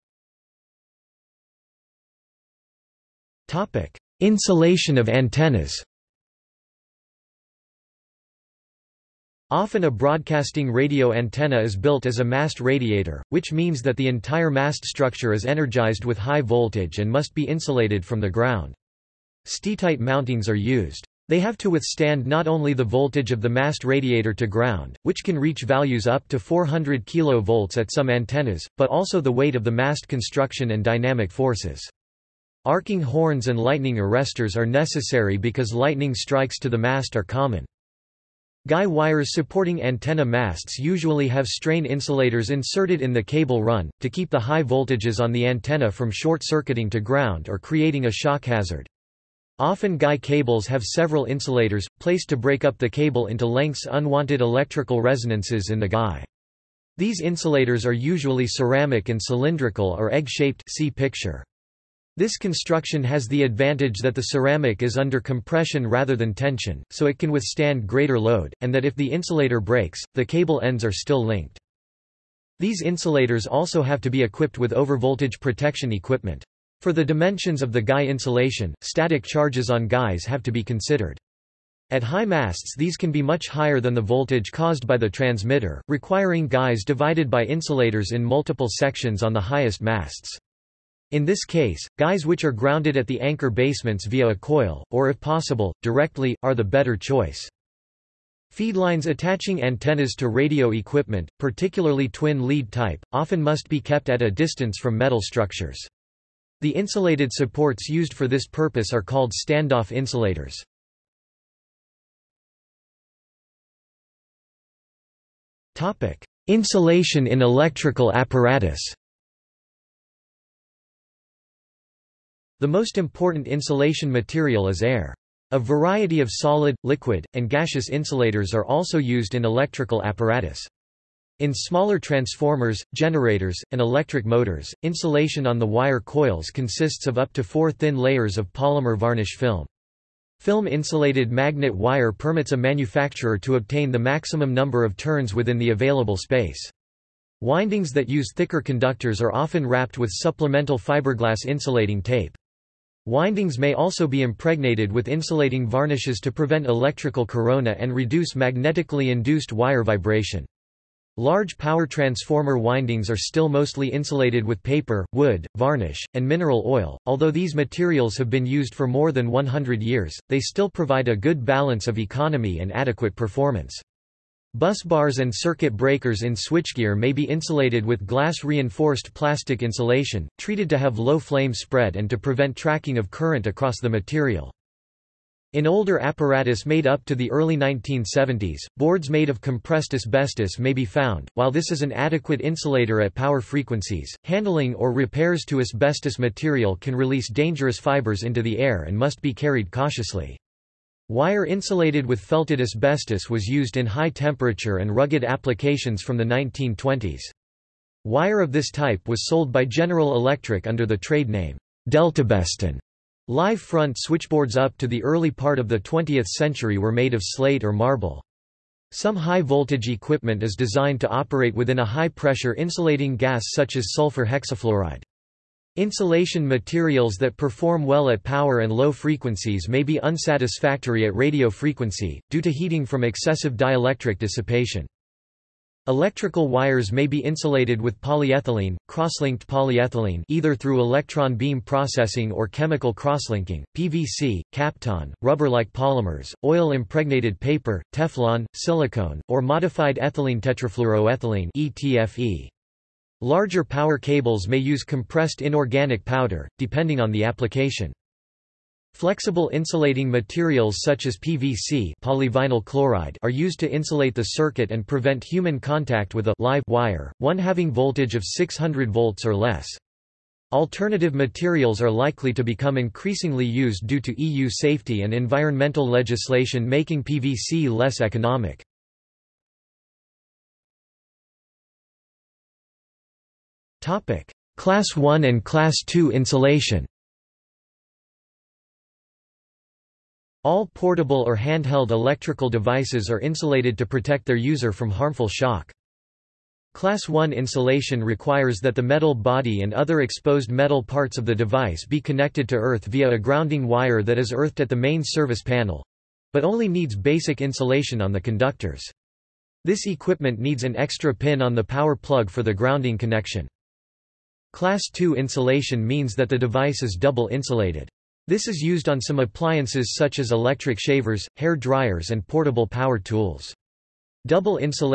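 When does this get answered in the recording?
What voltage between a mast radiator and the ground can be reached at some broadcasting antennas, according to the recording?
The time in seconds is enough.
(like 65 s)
26 s.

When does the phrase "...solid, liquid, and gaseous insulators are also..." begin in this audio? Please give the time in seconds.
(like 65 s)
126 s.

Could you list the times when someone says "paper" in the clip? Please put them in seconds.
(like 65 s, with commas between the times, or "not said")
164 s, 247 s.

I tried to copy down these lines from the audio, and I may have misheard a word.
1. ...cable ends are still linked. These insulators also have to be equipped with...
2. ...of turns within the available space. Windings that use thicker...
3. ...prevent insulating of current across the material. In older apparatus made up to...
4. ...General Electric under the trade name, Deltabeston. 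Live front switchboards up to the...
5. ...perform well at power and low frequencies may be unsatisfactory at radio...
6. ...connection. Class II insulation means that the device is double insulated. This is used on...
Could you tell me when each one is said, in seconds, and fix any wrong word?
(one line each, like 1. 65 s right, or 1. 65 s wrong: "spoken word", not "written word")
1. 70 s right
2. 144 s right
3. 182 s wrong: "tracking", not "insulating"
4. 209 s right
5. 227 s right
6. 312 s right.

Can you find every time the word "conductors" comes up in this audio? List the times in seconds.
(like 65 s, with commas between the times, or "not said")
148 s, 308 s.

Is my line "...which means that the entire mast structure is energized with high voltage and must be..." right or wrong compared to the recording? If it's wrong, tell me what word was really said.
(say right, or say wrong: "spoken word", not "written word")
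right.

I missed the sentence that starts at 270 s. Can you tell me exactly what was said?
Alternative materials are likely to become increasingly used due to EU safety and environmental legislation making PVC less economic.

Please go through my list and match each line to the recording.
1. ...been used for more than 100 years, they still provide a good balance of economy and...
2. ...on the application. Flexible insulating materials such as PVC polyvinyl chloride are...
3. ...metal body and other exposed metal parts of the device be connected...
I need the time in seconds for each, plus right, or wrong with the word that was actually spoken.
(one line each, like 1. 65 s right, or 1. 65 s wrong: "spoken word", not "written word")
1. 168 s right
2. 257 s right
3. 298 s right.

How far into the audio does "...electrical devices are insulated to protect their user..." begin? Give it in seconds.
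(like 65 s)
291 s.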